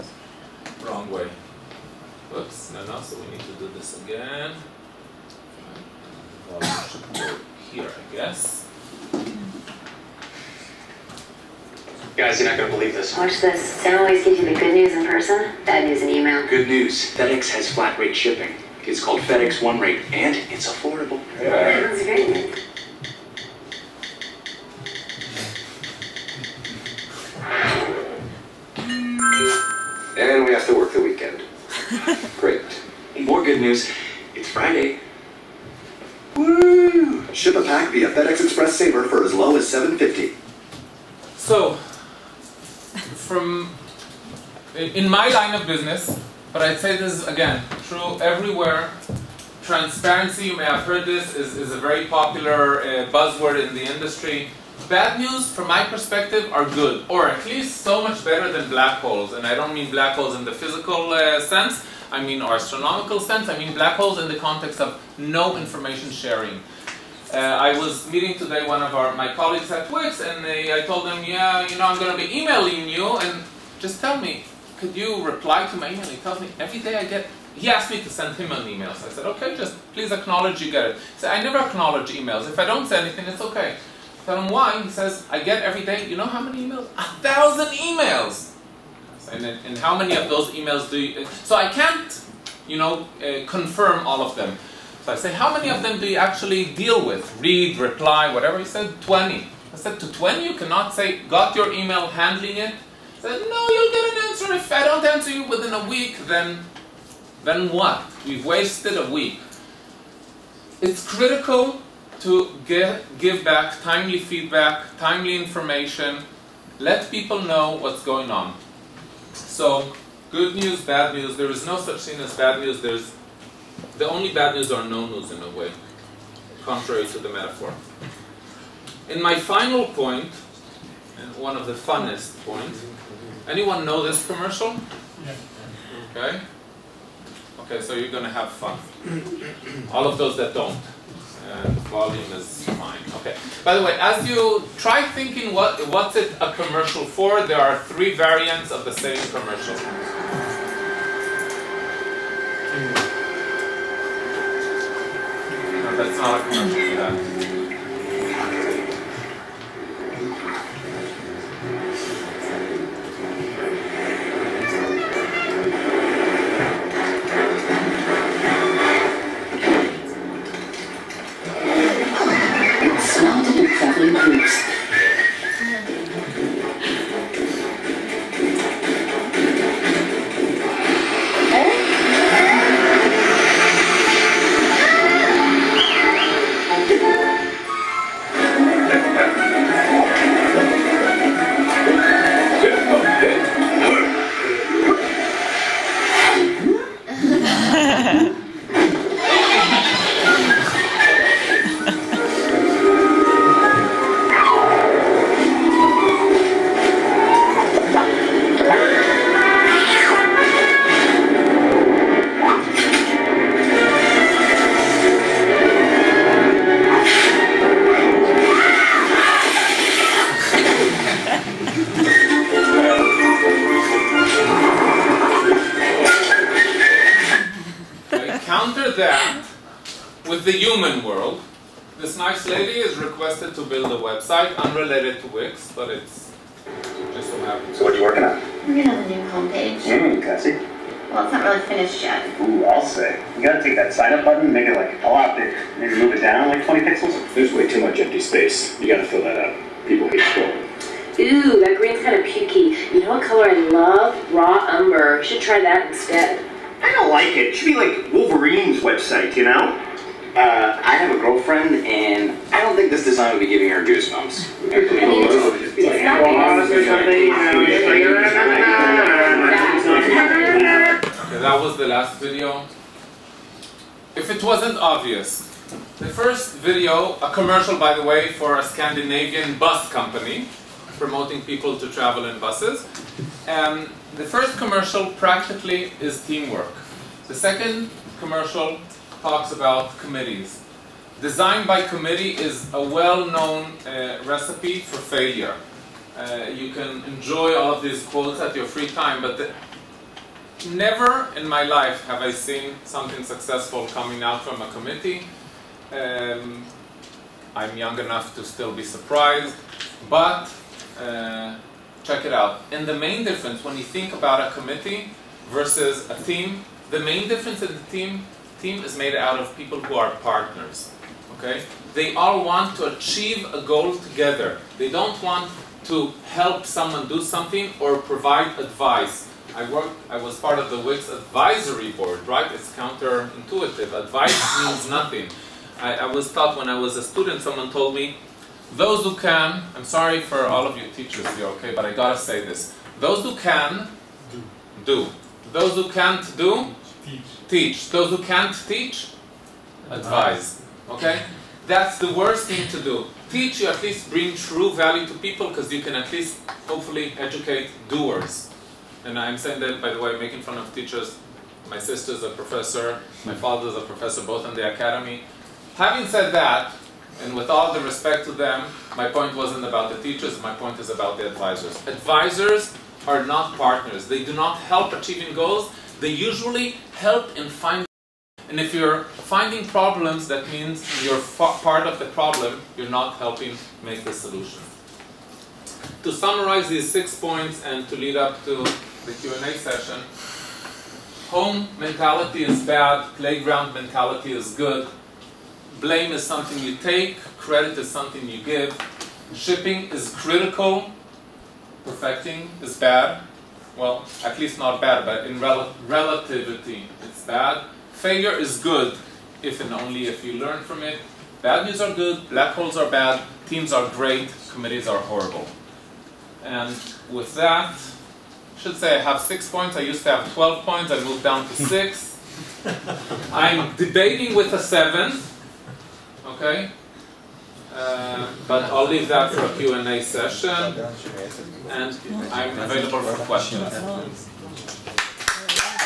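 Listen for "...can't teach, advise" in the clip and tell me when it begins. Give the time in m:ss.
5:48.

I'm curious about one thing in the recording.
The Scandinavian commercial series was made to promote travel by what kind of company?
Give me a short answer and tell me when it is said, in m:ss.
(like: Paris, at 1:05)
Bus company, at 4:39.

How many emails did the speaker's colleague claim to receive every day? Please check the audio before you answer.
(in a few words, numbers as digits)
1000.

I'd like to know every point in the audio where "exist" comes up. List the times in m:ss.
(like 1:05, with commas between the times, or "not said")
not said.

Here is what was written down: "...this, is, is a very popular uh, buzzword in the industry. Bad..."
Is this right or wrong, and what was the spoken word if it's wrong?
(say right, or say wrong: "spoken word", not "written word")
right.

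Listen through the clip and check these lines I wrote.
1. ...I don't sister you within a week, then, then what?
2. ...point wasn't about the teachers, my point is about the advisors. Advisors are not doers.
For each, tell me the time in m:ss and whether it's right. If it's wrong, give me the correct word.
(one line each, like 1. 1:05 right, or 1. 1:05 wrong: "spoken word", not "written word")
1. 1:44 wrong: "answer", not "sister"
2. 6:09 wrong: "partners", not "doers".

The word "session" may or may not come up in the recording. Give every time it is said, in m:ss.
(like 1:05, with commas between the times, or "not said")
6:29, 7:10.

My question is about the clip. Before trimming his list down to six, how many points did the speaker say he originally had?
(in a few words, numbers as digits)
12.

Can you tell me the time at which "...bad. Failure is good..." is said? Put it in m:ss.
6:47.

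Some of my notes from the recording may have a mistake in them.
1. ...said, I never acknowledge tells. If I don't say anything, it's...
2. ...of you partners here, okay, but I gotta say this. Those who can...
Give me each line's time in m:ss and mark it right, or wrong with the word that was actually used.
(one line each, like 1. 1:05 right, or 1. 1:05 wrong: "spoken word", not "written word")
1. 1:21 wrong: "emails", not "tells"
2. 5:40 wrong: "teachers", not "partners".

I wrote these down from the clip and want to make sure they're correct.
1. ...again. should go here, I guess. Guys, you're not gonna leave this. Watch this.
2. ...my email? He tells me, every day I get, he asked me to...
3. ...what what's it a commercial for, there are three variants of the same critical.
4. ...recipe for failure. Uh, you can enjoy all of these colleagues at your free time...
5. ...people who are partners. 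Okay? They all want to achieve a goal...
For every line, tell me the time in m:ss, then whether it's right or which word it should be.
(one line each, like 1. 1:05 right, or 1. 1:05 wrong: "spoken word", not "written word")
1. 0:04 wrong: "believe", not "leave"
2. 1:15 right
3. 2:25 wrong: "commercial", not "critical"
4. 4:54 wrong: "quotes", not "colleagues"
5. 5:19 right.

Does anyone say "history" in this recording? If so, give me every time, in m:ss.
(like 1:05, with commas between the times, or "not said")
not said.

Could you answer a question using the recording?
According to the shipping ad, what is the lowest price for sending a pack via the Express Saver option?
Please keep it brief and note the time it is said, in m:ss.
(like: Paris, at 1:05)
7.50, at 0:39.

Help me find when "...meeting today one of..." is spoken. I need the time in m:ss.
1:08.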